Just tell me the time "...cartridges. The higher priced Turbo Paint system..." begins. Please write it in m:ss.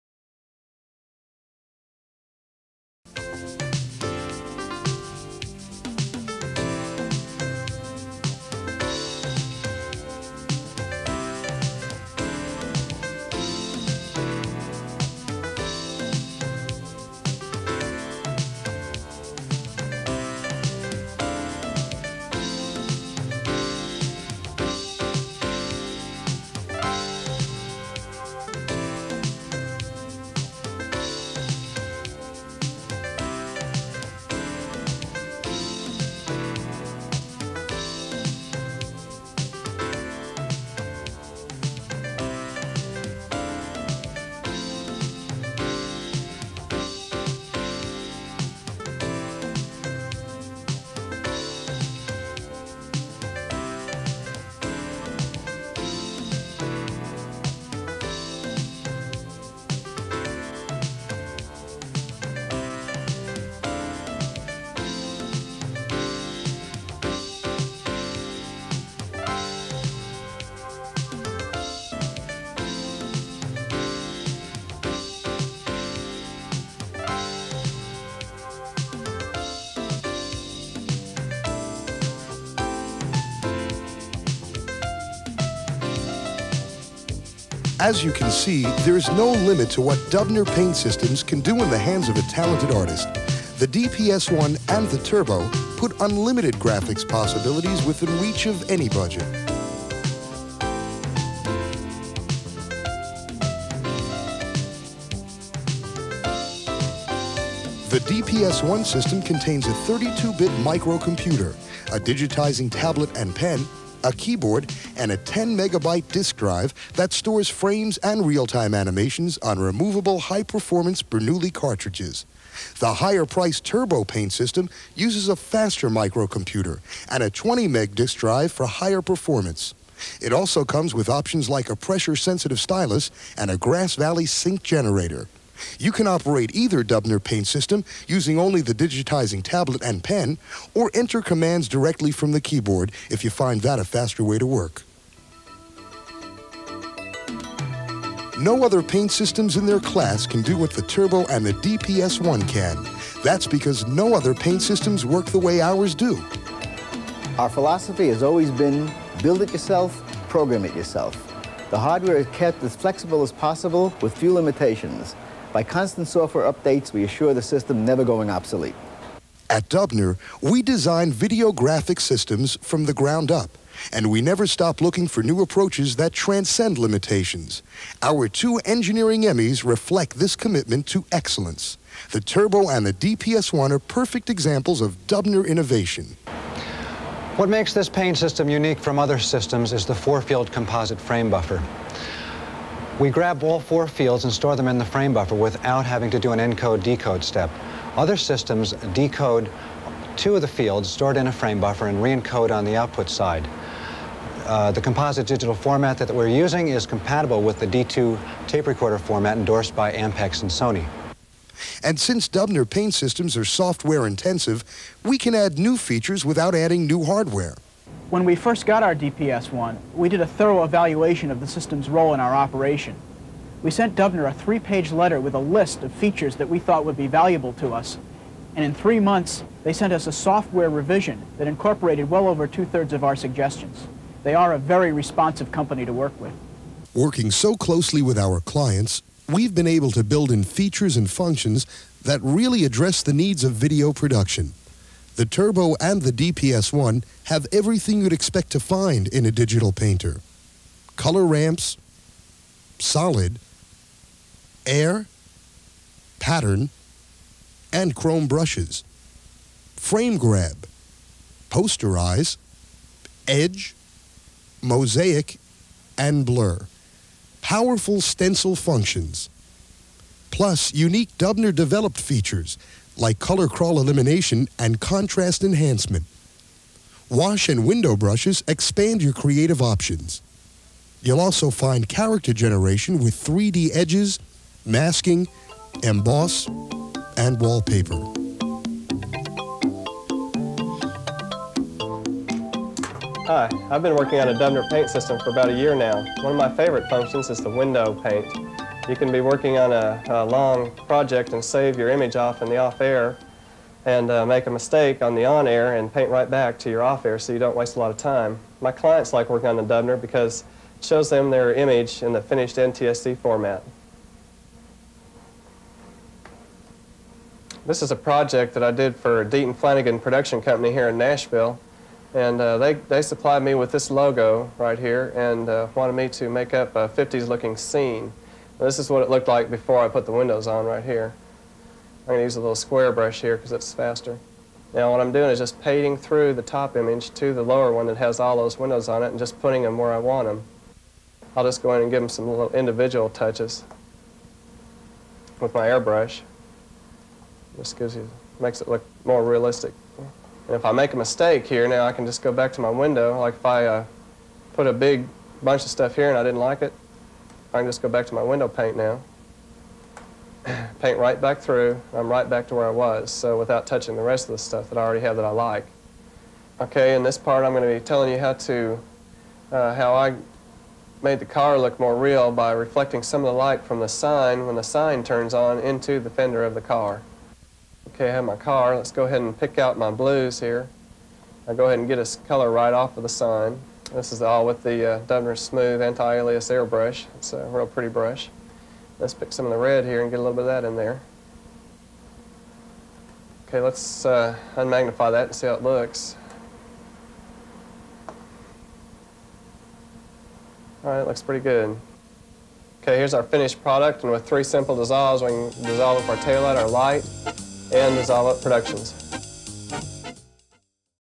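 2:01.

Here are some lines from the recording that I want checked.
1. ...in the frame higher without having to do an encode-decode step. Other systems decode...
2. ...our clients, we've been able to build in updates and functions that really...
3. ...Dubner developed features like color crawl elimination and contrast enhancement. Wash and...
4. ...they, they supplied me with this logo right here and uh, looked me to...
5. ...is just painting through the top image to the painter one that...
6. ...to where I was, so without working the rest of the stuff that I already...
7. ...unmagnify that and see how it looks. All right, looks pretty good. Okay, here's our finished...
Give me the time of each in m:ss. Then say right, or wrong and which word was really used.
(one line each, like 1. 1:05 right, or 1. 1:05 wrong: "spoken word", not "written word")
1. 3:14 wrong: "buffer", not "higher"
2. 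3:58 wrong: "features", not "updates"
3. 4:31 right
4. 5:22 wrong: "wanted", not "looked"
5. 5:35 wrong: "lower", not "painter"
6. 6:02 wrong: "touching", not "working"
7. 6:34 right.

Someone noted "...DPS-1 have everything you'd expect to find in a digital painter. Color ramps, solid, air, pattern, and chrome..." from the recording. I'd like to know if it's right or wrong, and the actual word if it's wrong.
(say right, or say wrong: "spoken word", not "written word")
right.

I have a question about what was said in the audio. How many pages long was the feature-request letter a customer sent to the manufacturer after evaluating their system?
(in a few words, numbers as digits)
3.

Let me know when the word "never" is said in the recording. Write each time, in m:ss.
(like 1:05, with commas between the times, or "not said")
2:47, 2:54.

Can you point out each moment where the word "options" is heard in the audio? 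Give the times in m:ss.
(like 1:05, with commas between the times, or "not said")
2:11, 4:39.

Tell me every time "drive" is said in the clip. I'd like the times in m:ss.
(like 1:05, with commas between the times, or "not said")
1:56, 2:08.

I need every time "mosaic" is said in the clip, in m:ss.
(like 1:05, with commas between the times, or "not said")
4:24.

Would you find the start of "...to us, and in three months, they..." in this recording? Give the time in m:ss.
3:47.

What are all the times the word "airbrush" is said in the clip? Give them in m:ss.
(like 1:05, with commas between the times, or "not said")
5:45, 6:26.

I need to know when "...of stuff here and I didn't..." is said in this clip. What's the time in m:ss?
5:55.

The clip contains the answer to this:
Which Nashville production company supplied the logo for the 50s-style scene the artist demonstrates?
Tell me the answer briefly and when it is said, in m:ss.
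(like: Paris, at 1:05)
Deaton Flanagan, at 5:19.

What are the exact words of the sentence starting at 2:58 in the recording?
Our two engineering Emmys reflect this commitment to excellence.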